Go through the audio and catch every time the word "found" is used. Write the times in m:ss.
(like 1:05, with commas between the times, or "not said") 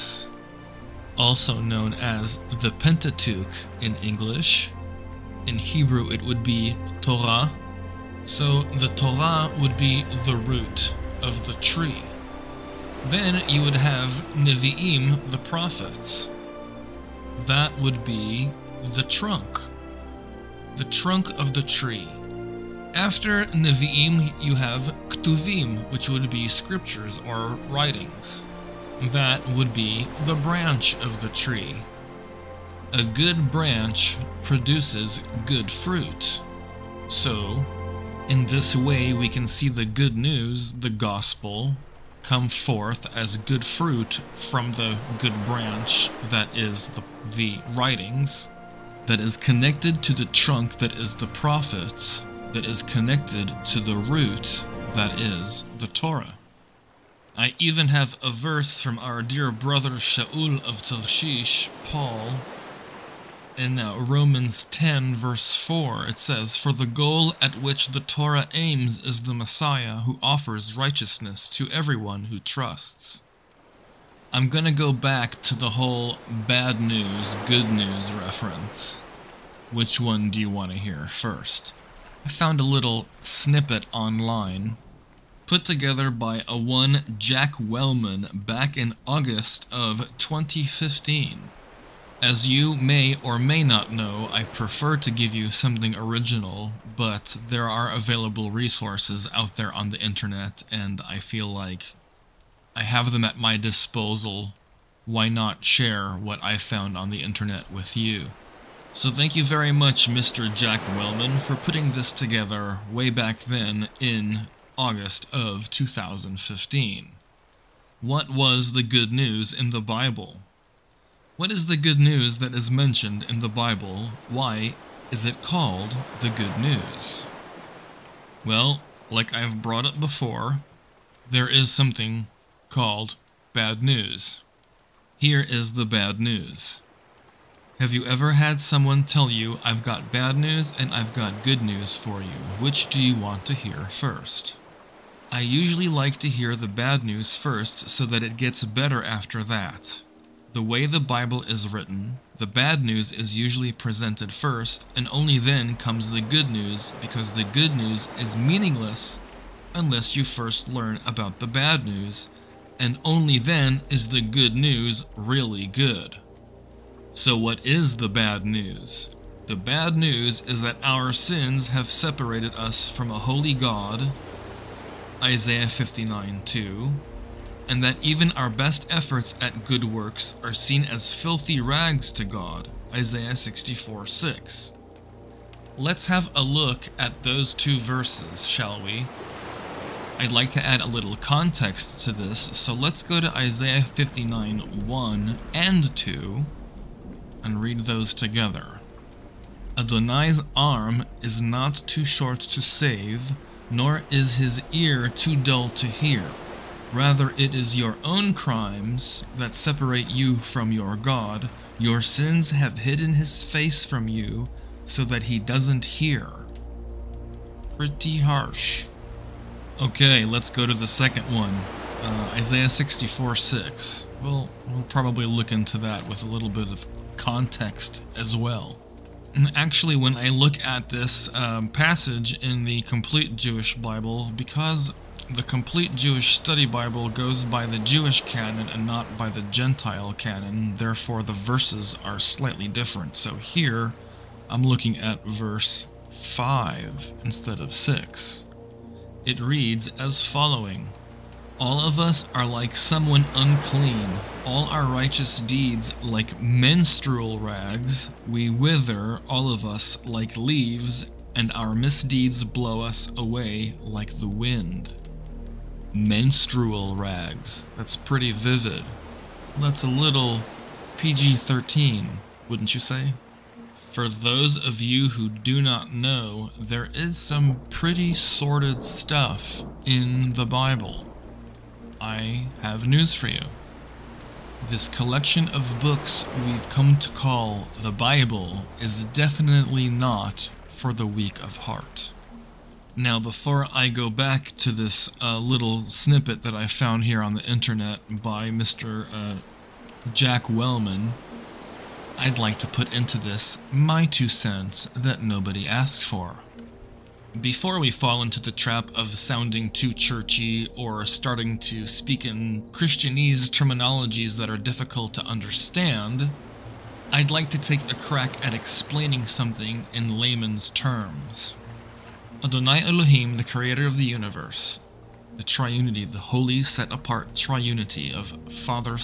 1:22, 1:46, 4:56.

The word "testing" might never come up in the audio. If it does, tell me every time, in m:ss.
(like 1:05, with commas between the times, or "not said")
not said.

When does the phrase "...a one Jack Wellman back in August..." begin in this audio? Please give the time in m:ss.
1:26.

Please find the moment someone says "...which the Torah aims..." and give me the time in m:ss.
1:07.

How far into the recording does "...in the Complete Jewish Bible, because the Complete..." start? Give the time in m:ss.
3:52.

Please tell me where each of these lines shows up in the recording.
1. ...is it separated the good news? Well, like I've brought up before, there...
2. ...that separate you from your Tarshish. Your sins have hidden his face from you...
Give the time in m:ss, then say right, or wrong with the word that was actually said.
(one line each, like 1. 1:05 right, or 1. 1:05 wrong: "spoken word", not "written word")
1. 2:05 wrong: "called", not "separated"
2. 3:29 wrong: "God", not "Tarshish".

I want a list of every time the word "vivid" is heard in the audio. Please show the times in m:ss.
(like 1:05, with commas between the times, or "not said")
4:28.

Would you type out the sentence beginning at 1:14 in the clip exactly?
I'm gonna go back to the whole bad news, good news reference.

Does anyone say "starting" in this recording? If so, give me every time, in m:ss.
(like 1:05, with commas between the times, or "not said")
5:11.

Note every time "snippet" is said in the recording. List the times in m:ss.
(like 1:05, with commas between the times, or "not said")
1:23, 4:55.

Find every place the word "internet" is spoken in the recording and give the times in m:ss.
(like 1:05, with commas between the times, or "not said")
1:40, 1:47, 4:57.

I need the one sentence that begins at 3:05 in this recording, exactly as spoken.
Let's have a look at those two verses, shall we?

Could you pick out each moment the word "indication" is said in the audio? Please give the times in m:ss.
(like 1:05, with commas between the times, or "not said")
not said.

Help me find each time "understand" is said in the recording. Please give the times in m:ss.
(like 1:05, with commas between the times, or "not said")
5:15.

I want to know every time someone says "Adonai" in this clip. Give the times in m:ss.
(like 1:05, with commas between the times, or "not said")
3:19, 5:22.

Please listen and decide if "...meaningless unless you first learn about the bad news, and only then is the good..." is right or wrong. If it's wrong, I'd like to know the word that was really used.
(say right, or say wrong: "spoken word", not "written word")
right.